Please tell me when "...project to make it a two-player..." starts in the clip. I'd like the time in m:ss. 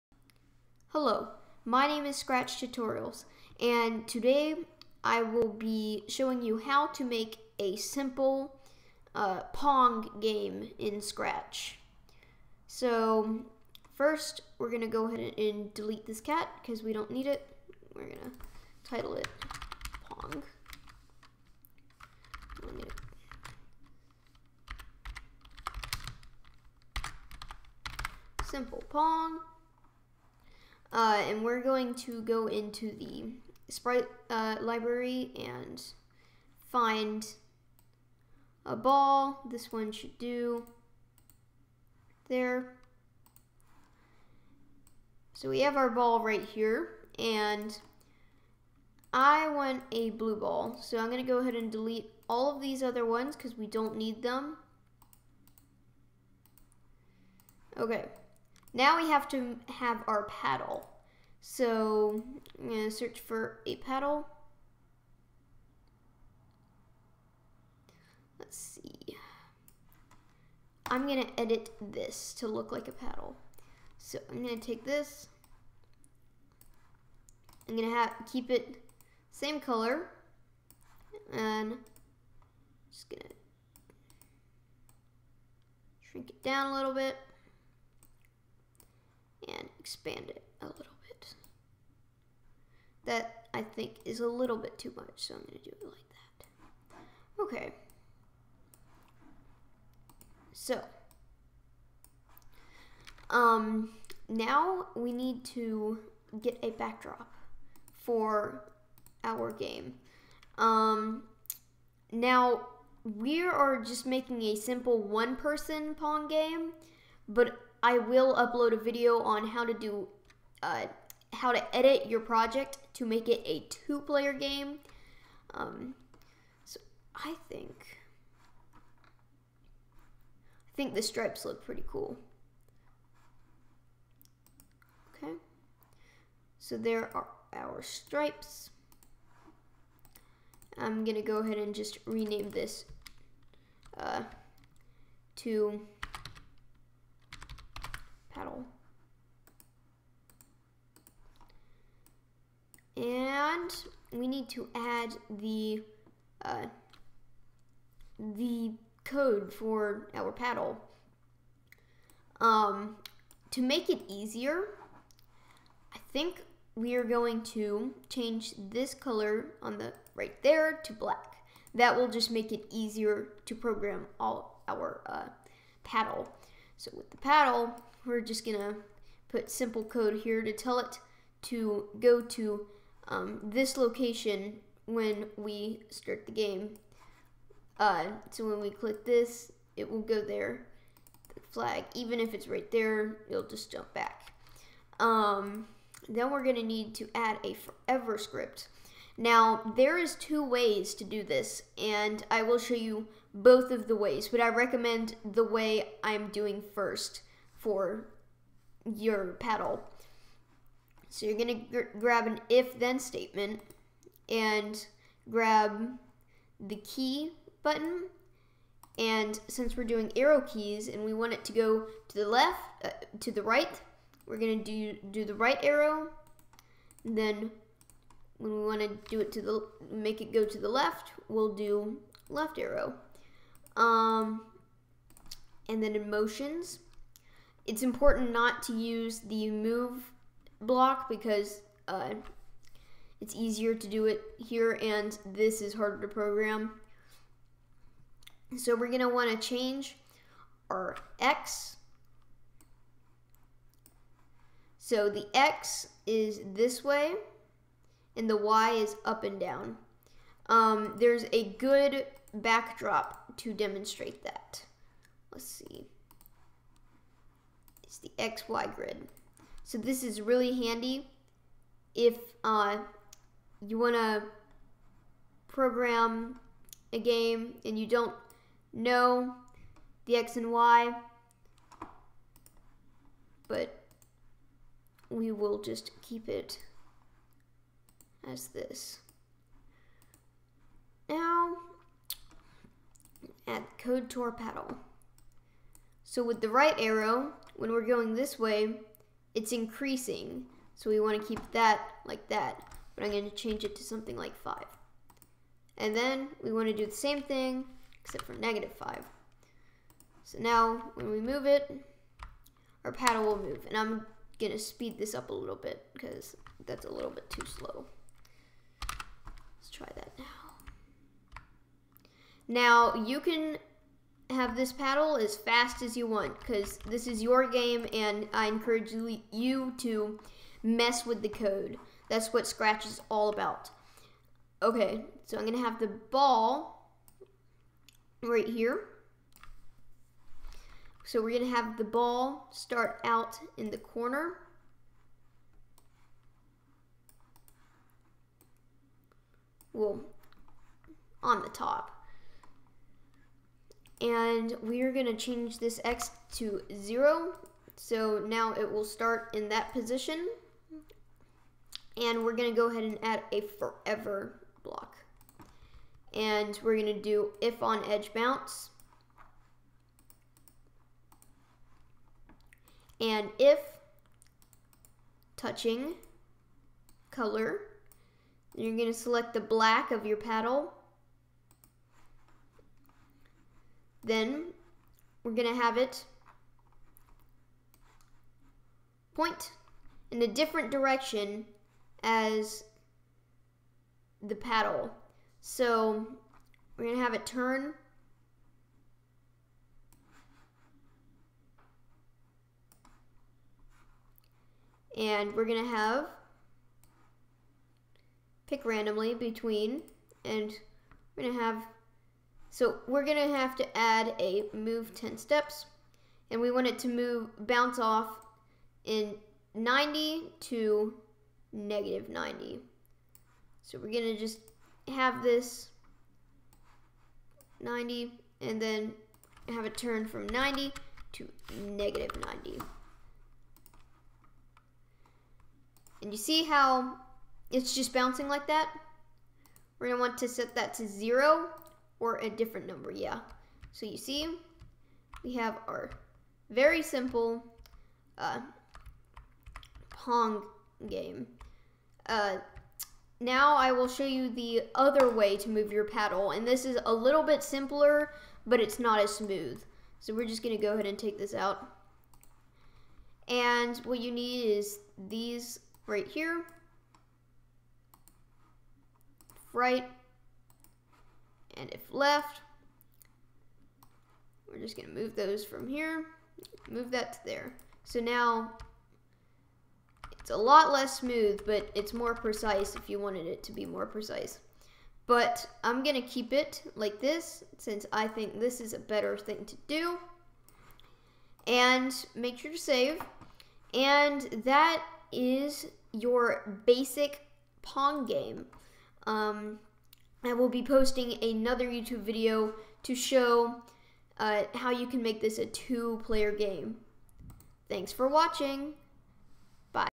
2:02.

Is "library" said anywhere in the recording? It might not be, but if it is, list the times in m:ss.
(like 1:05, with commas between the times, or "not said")
0:34.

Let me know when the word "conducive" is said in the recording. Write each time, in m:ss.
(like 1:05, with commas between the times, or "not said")
not said.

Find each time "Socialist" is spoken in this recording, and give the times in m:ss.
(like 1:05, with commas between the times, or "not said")
not said.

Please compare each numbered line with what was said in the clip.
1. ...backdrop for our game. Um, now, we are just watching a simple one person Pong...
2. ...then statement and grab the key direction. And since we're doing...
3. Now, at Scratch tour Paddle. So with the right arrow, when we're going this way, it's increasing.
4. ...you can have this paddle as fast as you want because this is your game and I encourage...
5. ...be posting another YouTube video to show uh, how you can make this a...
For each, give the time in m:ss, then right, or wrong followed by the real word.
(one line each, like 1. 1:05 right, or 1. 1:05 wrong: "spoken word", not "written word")
1. 1:46 wrong: "making", not "watching"
2. 3:32 wrong: "button", not "direction"
3. 4:51 wrong: "Code", not "Scratch"
4. 5:22 right
5. 8:20 right.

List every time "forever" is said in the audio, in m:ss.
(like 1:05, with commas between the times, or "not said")
3:17, 6:03.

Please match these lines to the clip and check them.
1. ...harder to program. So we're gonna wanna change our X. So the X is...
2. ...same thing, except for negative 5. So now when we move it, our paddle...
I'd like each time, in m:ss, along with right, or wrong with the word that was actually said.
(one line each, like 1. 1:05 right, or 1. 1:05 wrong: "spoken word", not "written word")
1. 4:05 right
2. 5:06 right.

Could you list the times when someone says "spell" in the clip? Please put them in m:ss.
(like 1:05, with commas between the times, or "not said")
not said.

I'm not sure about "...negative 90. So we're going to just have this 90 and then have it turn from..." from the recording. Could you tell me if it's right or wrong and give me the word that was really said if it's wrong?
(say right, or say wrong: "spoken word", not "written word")
right.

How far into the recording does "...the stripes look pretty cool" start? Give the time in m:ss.
2:10.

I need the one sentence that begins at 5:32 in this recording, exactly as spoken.
That's what Scratch is all about.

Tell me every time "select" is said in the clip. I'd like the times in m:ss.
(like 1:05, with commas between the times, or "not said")
6:18.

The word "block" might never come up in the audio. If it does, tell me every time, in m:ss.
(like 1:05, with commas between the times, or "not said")
4:00, 6:04.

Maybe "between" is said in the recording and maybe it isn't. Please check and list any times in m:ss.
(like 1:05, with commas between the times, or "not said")
6:49.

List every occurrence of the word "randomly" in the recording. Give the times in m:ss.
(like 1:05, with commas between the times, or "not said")
6:48.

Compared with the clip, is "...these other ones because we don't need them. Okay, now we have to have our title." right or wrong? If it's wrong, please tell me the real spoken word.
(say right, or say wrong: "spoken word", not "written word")
wrong: "paddle", not "title".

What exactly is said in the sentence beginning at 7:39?
So we're just gonna go ahead and take this out.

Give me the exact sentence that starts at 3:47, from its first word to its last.
then when we want to do it to the, make it go to the left, we'll do left arrow.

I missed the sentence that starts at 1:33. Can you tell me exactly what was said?
That I think is a little bit too much, so I'm going to do it like that.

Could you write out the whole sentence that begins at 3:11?
The flag, even if it's right there, it'll just jump back.